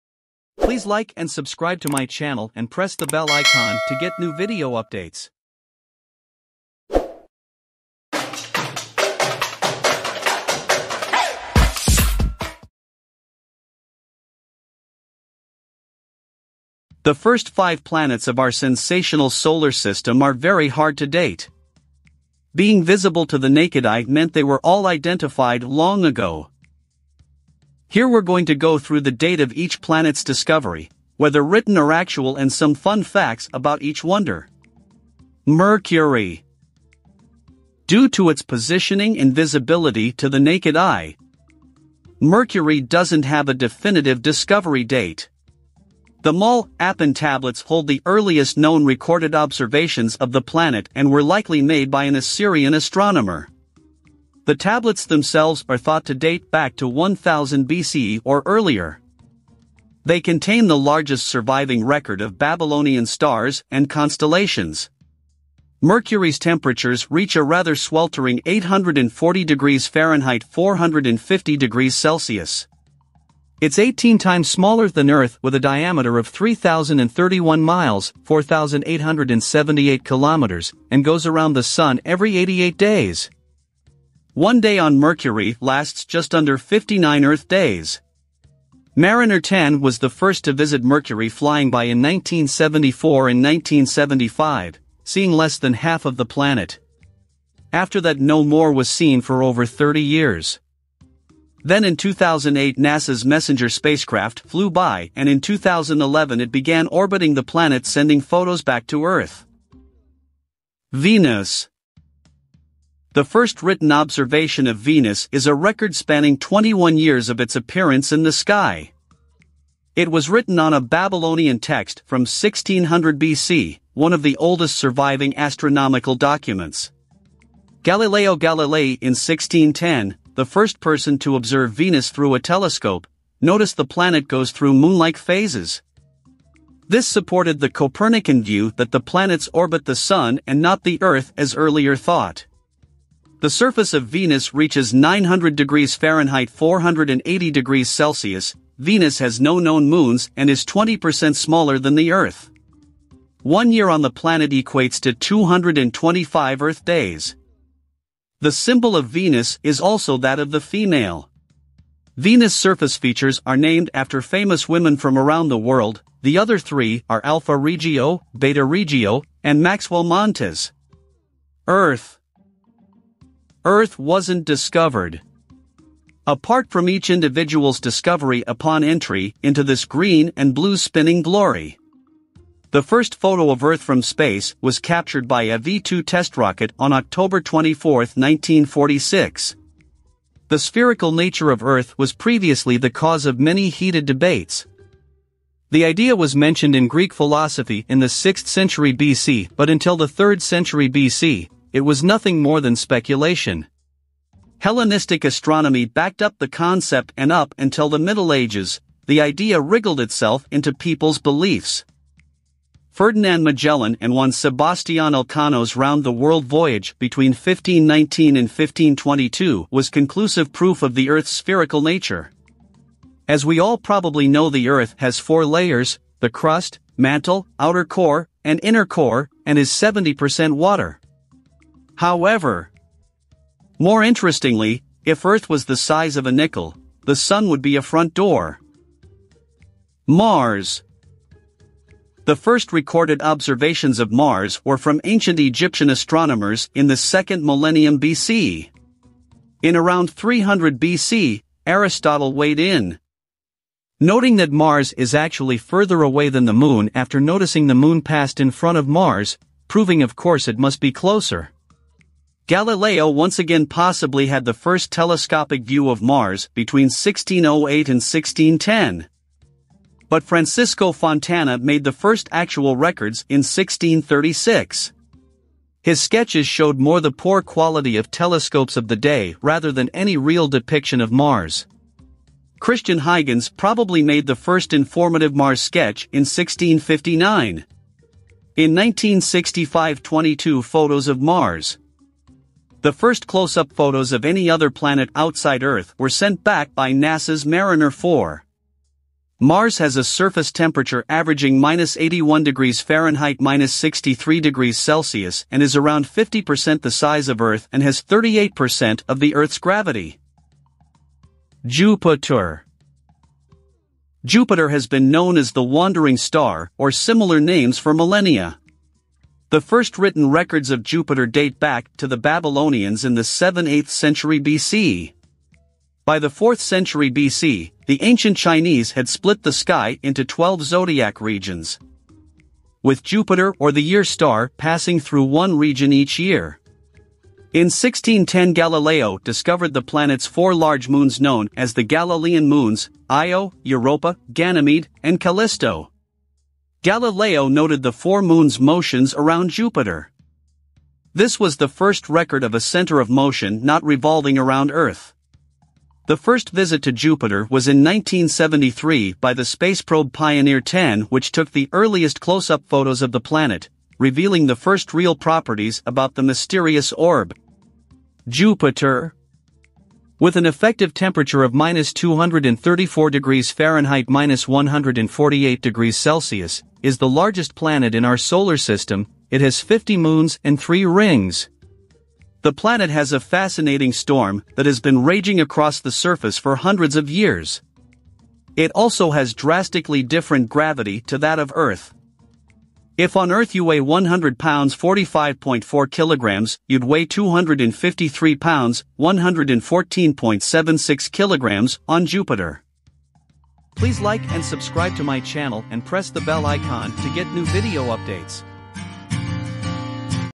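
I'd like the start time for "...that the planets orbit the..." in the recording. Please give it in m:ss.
2:18.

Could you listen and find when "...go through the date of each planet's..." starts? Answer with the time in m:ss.
0:28.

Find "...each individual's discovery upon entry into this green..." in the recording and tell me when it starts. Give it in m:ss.
2:56.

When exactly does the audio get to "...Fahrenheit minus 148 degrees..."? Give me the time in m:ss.
6:13.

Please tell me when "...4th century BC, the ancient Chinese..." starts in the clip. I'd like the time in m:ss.
5:26.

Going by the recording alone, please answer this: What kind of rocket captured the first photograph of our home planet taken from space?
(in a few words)
V-2 test rocket.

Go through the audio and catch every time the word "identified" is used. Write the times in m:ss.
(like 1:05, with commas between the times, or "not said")
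0:24.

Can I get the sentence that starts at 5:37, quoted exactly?
In 1610 Galileo discovered the planet's four large moons known as the Galilean moons, Io, Europa, Ganymede, and Callisto.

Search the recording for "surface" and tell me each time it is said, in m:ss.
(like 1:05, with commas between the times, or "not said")
2:23, 2:42, 5:00, 6:25.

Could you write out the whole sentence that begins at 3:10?
The spherical nature of Earth was previously the cause of many heated debates.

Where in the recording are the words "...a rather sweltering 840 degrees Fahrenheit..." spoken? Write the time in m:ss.
1:07.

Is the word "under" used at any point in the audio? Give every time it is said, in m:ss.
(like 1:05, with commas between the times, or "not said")
1:26.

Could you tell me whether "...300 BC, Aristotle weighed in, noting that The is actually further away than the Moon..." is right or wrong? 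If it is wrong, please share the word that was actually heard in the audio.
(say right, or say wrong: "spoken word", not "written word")
wrong: "Mars", not "The".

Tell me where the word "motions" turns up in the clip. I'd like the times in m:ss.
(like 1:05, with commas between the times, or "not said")
5:48, 5:53.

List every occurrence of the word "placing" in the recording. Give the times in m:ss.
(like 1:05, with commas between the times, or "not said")
not said.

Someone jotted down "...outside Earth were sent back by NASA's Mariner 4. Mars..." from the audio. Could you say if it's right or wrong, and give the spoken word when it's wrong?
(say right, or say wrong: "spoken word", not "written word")
right.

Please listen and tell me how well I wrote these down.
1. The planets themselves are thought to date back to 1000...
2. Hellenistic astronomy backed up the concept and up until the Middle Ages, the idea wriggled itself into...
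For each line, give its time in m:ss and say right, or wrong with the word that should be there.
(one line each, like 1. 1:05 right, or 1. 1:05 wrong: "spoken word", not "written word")
1. 0:54 wrong: "tablets", not "planets"
2. 3:24 right.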